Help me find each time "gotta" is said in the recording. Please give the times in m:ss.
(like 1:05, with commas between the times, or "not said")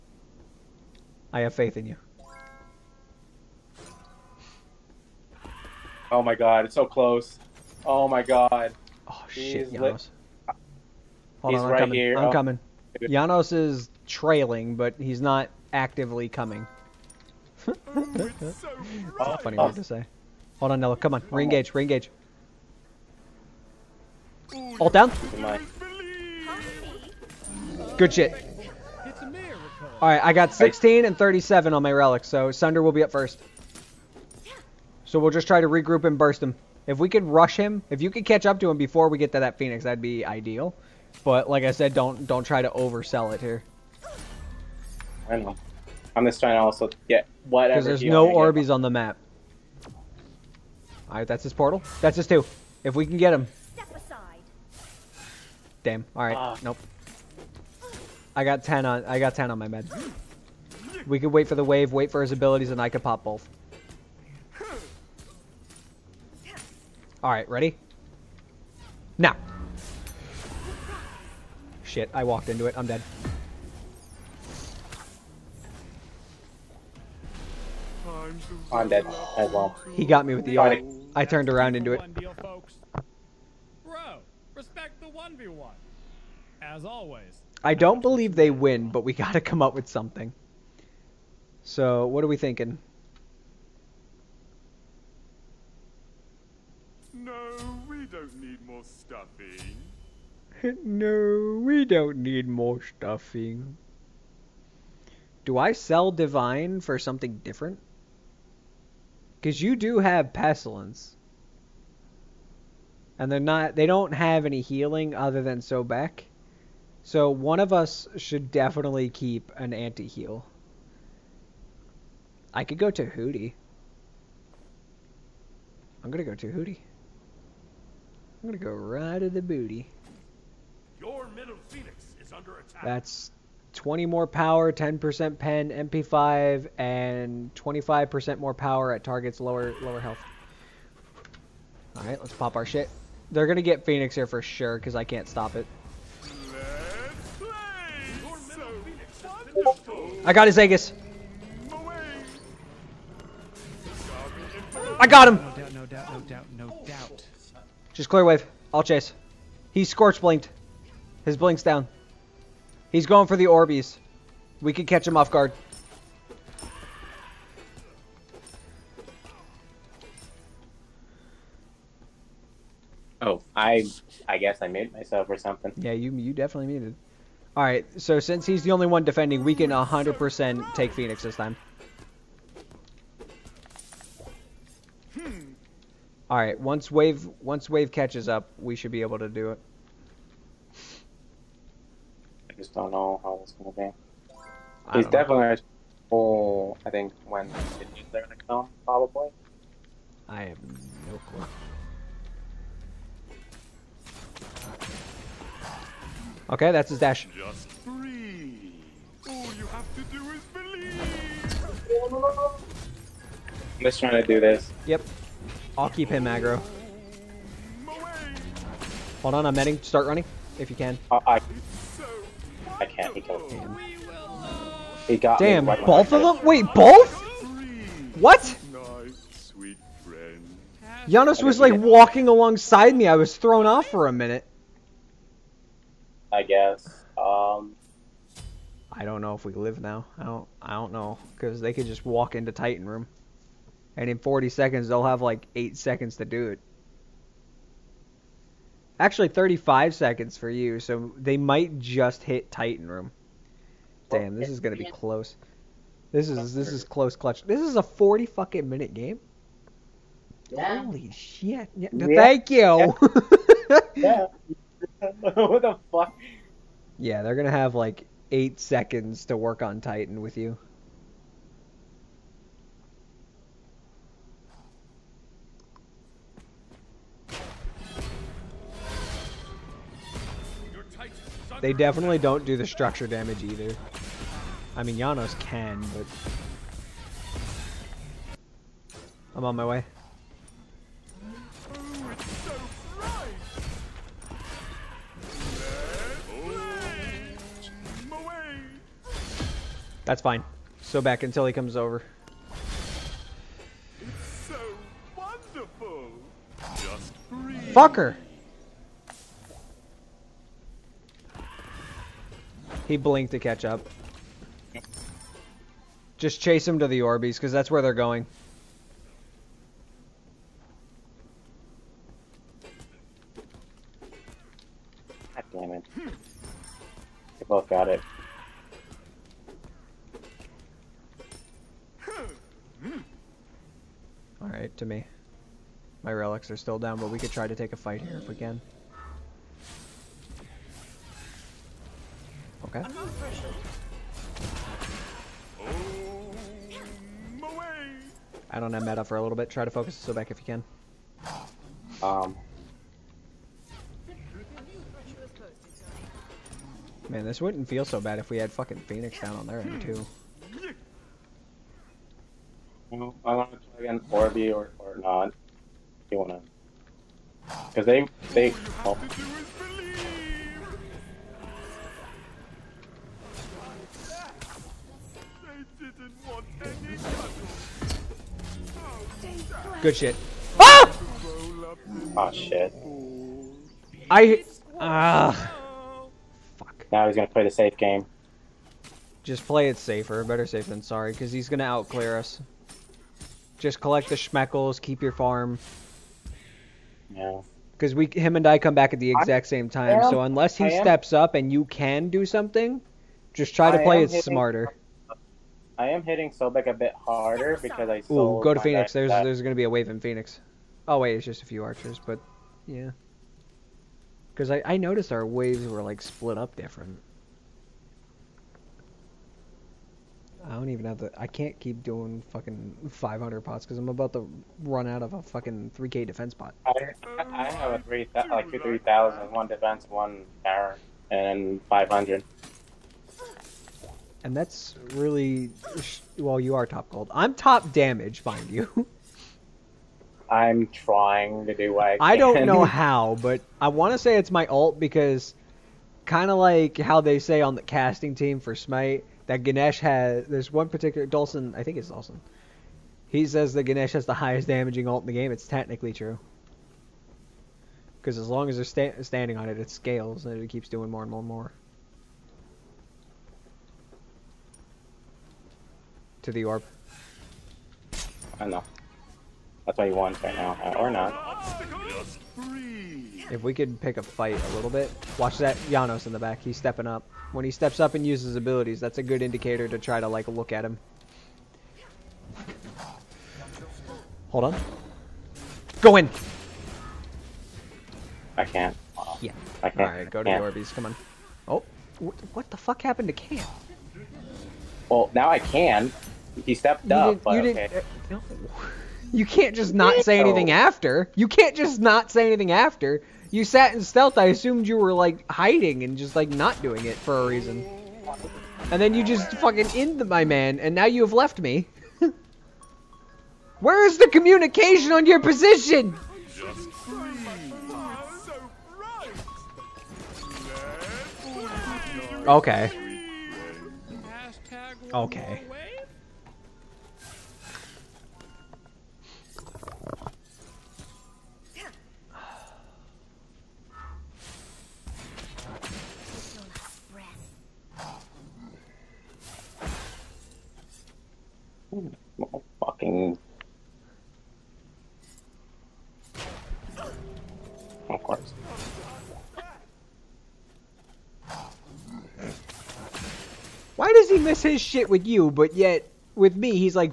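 1:29.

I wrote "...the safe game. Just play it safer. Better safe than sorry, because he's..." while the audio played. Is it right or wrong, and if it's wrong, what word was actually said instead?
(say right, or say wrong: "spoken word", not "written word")
right.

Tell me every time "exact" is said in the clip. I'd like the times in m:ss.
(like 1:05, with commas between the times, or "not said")
6:39.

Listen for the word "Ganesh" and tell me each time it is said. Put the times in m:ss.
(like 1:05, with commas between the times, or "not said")
7:29, 7:33.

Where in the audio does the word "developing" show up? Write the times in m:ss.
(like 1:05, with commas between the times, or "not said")
not said.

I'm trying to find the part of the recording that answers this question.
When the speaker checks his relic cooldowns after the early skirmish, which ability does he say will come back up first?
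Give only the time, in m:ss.
0:32.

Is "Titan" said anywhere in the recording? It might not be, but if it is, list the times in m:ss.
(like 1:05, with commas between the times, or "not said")
4:02, 4:12, 4:29.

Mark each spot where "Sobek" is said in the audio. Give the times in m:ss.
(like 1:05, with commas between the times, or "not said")
1:55, 5:50, 6:46.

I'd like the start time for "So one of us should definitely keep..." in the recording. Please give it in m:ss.
1:57.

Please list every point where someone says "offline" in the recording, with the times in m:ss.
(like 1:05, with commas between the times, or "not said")
not said.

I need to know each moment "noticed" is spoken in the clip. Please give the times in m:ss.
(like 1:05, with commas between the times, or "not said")
6:54.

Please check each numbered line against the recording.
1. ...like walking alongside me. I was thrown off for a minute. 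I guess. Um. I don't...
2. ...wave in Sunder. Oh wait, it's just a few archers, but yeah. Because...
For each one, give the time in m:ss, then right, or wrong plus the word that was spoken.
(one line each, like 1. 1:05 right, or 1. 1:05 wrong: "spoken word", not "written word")
1. 3:51 right
2. 6:49 wrong: "Phoenix", not "Sunder".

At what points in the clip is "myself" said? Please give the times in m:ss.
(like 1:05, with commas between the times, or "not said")
2:54.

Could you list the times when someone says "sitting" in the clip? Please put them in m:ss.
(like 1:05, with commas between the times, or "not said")
not said.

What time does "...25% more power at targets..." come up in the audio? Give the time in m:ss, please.
2:17.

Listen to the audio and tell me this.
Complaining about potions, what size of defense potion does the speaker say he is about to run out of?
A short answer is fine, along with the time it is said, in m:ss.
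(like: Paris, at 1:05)
3k, at 7:05.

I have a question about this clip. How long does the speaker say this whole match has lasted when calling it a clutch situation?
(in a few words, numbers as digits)
40 minutes.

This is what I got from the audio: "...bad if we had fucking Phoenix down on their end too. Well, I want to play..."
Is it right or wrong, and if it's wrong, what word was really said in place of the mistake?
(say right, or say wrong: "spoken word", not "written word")
right.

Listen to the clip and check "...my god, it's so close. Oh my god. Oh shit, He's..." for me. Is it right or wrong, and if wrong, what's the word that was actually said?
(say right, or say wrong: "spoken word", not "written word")
right.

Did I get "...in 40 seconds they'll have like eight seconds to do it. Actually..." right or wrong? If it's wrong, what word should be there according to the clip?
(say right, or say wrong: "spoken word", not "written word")
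right.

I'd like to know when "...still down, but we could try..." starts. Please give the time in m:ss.
5:36.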